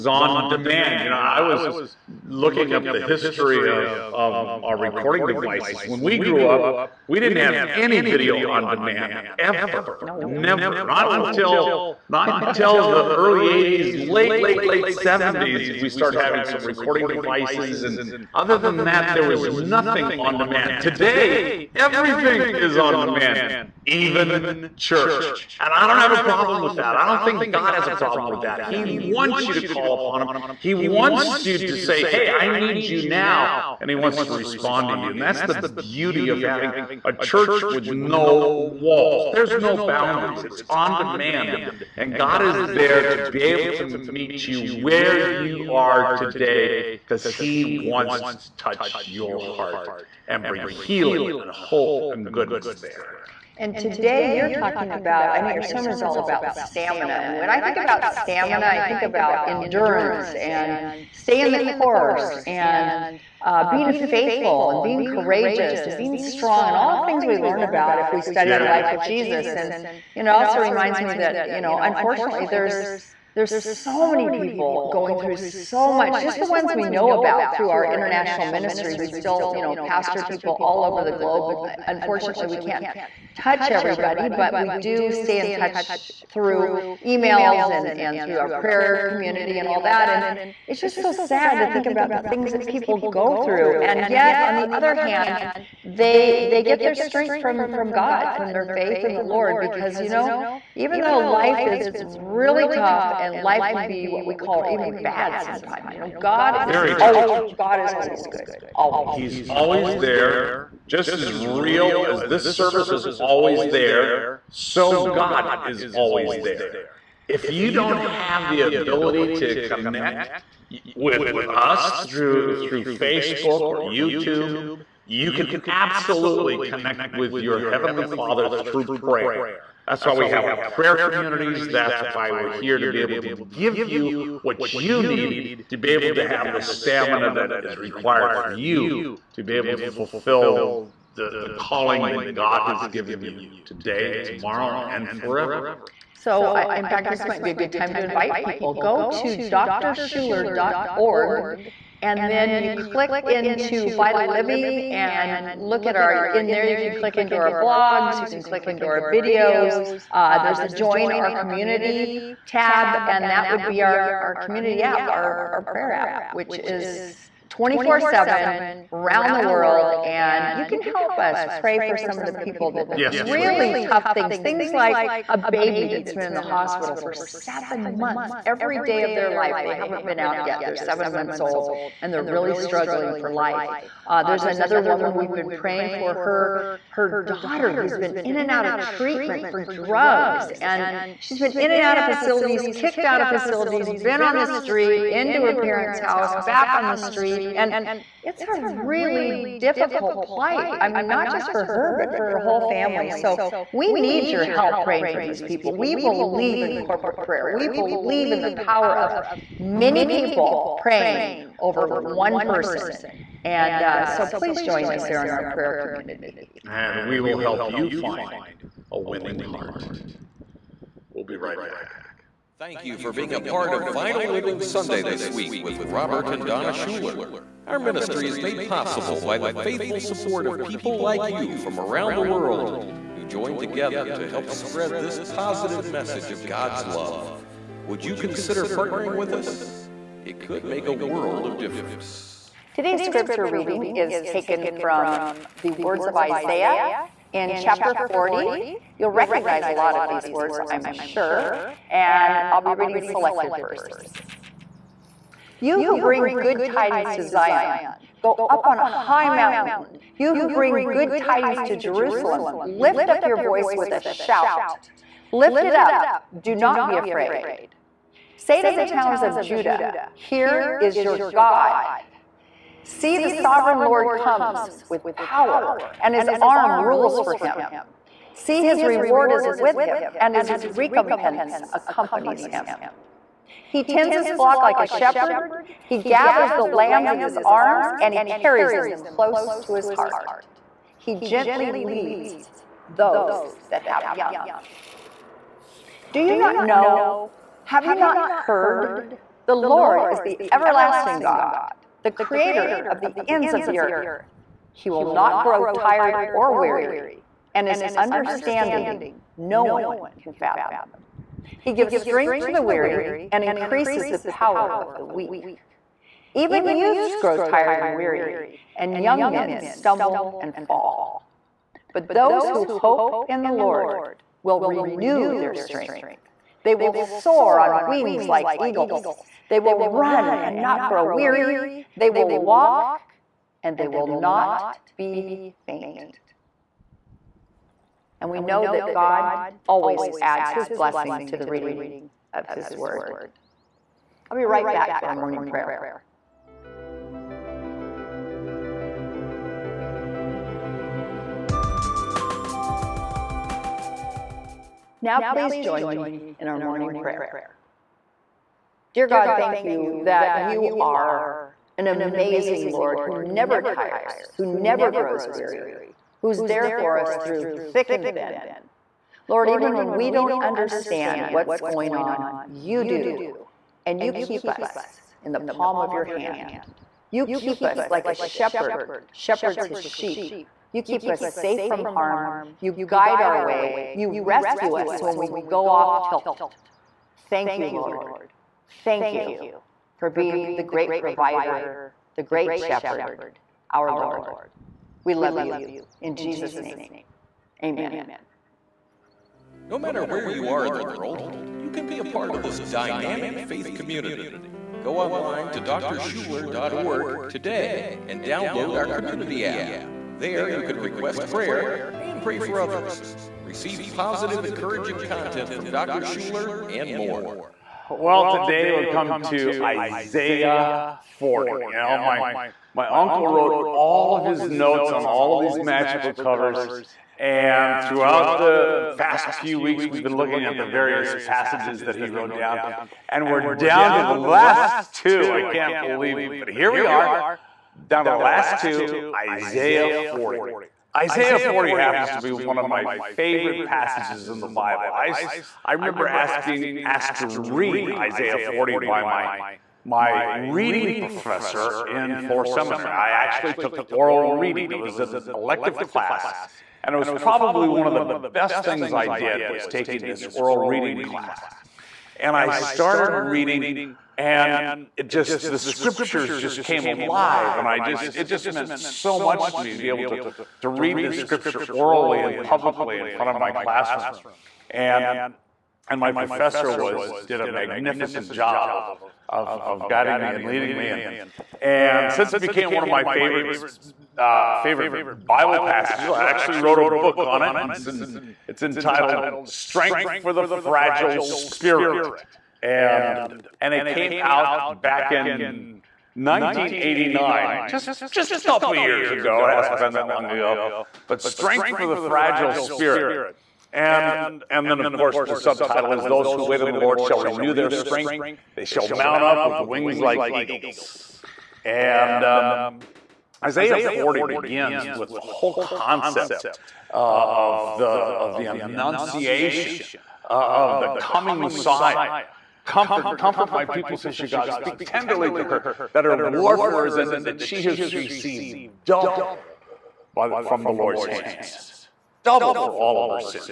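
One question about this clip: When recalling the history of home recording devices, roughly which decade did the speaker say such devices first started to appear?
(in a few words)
late 70s.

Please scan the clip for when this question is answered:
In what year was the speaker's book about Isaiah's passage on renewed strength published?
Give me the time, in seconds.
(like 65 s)
496 s.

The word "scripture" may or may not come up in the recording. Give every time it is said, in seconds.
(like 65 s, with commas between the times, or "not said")
243 s, 465 s, 471 s.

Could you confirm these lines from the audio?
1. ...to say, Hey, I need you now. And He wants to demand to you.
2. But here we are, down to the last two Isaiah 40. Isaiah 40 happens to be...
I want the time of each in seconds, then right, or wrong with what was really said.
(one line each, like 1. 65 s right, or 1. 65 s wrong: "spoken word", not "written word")
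1. 31 s wrong: "respond", not "demand"
2. 436 s right.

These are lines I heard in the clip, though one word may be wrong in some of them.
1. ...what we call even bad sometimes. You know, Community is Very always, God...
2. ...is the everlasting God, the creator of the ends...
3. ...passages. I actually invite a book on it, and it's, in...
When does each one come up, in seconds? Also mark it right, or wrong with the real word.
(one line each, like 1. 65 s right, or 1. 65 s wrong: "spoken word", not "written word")
1. 104 s wrong: "God", not "Community"
2. 300 s right
3. 485 s wrong: "wrote", not "invite".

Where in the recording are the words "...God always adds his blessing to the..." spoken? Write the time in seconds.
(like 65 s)
338 s.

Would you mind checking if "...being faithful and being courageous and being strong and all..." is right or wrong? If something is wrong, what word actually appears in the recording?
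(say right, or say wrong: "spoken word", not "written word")
right.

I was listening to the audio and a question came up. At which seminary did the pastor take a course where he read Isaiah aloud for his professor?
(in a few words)
Fuller Seminary.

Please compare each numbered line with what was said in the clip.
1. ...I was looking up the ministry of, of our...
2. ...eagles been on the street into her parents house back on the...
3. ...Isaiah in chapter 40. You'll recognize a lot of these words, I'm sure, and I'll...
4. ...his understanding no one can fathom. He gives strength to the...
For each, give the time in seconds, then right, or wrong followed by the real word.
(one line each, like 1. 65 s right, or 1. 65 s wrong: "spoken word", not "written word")
1. 1 s wrong: "history", not "ministry"
2. 193 s wrong: "facilities", not "eagles"
3. 246 s right
4. 307 s right.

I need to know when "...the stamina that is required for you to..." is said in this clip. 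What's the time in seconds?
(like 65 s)
136 s.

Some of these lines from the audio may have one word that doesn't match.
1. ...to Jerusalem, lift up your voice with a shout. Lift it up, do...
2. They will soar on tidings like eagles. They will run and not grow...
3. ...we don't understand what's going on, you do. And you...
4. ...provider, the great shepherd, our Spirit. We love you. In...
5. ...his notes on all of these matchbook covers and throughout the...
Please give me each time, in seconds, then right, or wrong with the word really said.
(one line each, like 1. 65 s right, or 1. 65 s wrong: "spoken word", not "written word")
1. 261 s right
2. 326 s wrong: "wings", not "tidings"
3. 369 s right
4. 390 s wrong: "Lord", not "Spirit"
5. 424 s right.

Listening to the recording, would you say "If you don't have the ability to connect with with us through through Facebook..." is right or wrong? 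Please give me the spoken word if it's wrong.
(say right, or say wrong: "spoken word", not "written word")
right.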